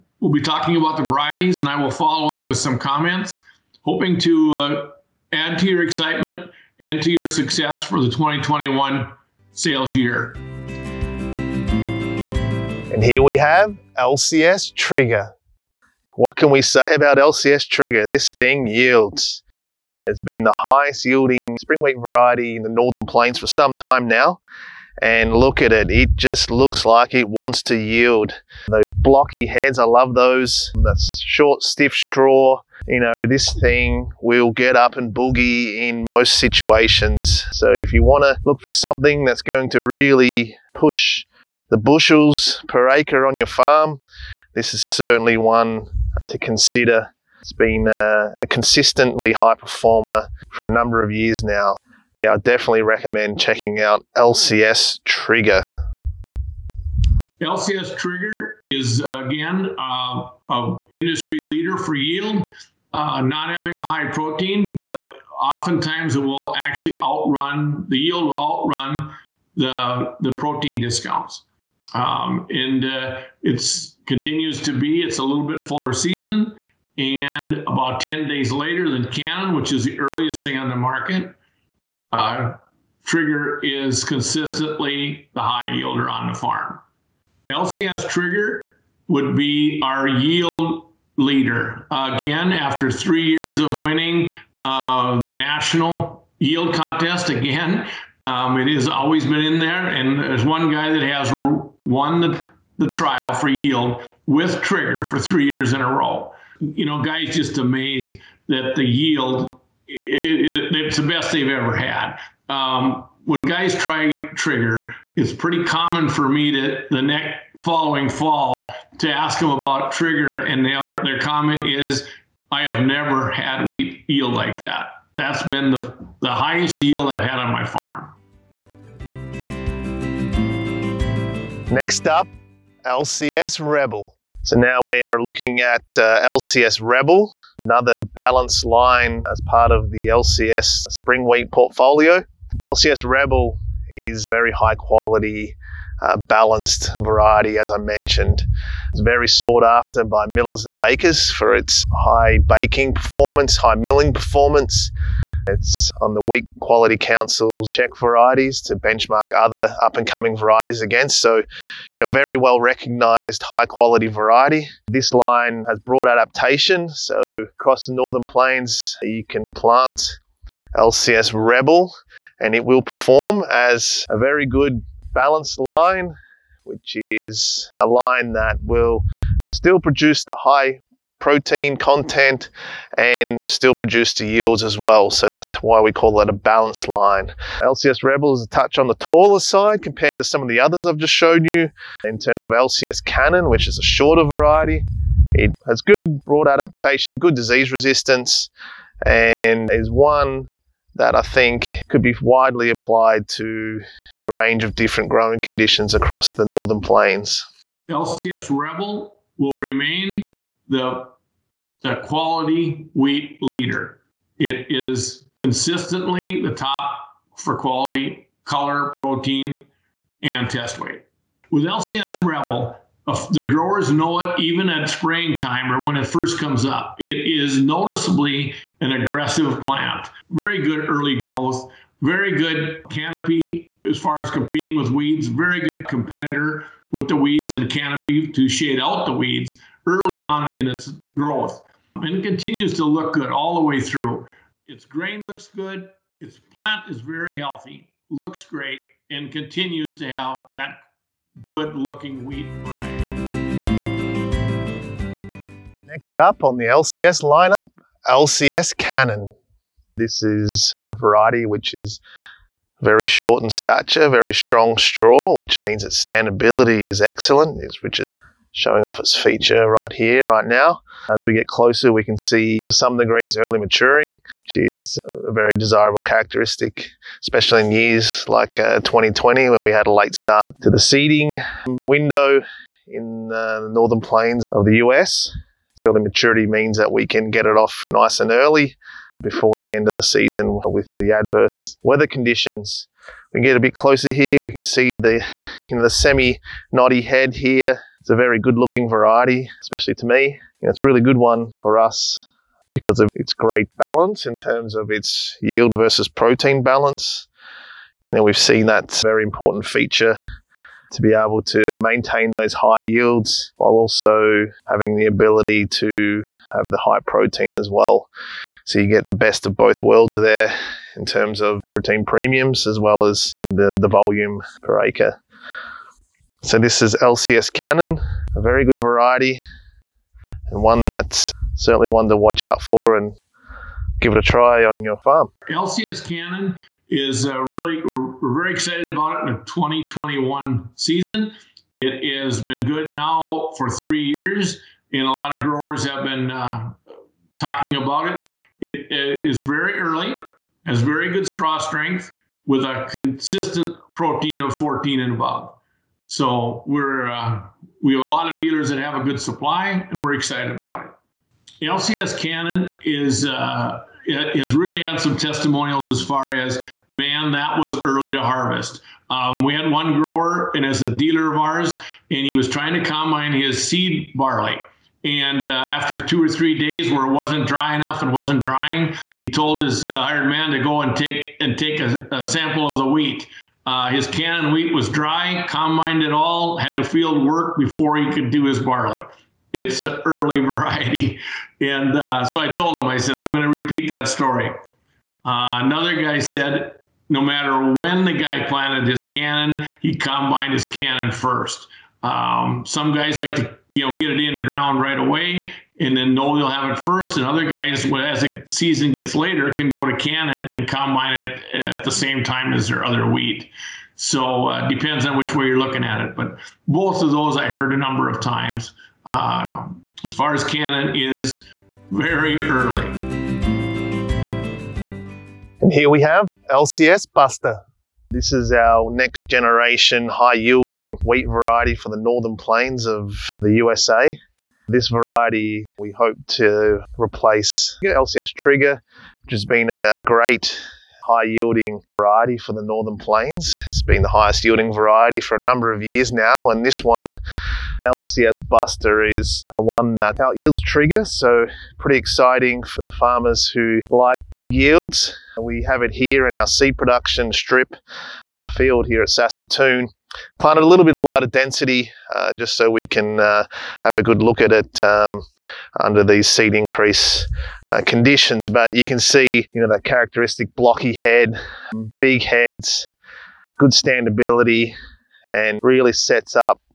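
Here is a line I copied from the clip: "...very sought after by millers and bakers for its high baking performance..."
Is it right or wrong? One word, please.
right.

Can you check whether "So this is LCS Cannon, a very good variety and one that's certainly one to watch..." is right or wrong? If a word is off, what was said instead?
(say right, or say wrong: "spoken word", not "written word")
right.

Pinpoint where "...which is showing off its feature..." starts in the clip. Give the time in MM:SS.
04:27.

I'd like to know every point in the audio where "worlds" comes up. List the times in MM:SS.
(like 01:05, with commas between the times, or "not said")
05:19.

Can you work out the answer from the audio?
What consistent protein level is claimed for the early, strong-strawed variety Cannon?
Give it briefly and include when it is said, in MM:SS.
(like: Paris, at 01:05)
14 and above, at 05:54.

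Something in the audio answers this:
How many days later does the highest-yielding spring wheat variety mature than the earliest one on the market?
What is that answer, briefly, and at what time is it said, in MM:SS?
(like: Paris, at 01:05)
10 days, at 01:18.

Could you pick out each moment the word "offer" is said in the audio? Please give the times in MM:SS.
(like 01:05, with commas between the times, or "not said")
not said.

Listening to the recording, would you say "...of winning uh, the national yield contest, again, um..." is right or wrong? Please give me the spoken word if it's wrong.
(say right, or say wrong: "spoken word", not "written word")
right.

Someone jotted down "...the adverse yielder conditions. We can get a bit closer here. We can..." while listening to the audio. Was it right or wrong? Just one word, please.
wrong.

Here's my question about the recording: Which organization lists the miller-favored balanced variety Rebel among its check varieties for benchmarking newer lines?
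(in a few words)
Wheat Quality Council.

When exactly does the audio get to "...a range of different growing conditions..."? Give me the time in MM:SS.
03:24.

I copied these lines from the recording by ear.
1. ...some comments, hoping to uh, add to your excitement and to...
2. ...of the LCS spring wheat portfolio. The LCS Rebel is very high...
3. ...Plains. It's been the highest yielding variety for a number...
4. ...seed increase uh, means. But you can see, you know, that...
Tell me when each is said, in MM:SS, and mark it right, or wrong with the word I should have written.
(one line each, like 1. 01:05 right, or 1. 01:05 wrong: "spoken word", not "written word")
1. 00:02 right
2. 02:19 right
3. 07:22 right
4. 07:46 wrong: "conditions", not "means".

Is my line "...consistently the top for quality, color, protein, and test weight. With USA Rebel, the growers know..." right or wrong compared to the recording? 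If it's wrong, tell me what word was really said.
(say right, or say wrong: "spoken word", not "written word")
wrong: "LCS", not "USA".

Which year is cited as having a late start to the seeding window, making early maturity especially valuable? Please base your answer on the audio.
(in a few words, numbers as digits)
2020.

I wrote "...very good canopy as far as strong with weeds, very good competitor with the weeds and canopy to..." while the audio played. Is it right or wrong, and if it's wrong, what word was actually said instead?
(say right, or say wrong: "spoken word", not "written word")
wrong: "competing", not "strong".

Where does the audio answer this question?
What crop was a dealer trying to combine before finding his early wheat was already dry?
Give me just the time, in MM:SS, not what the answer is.
06:13.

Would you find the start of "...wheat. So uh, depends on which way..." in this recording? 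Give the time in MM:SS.
06:53.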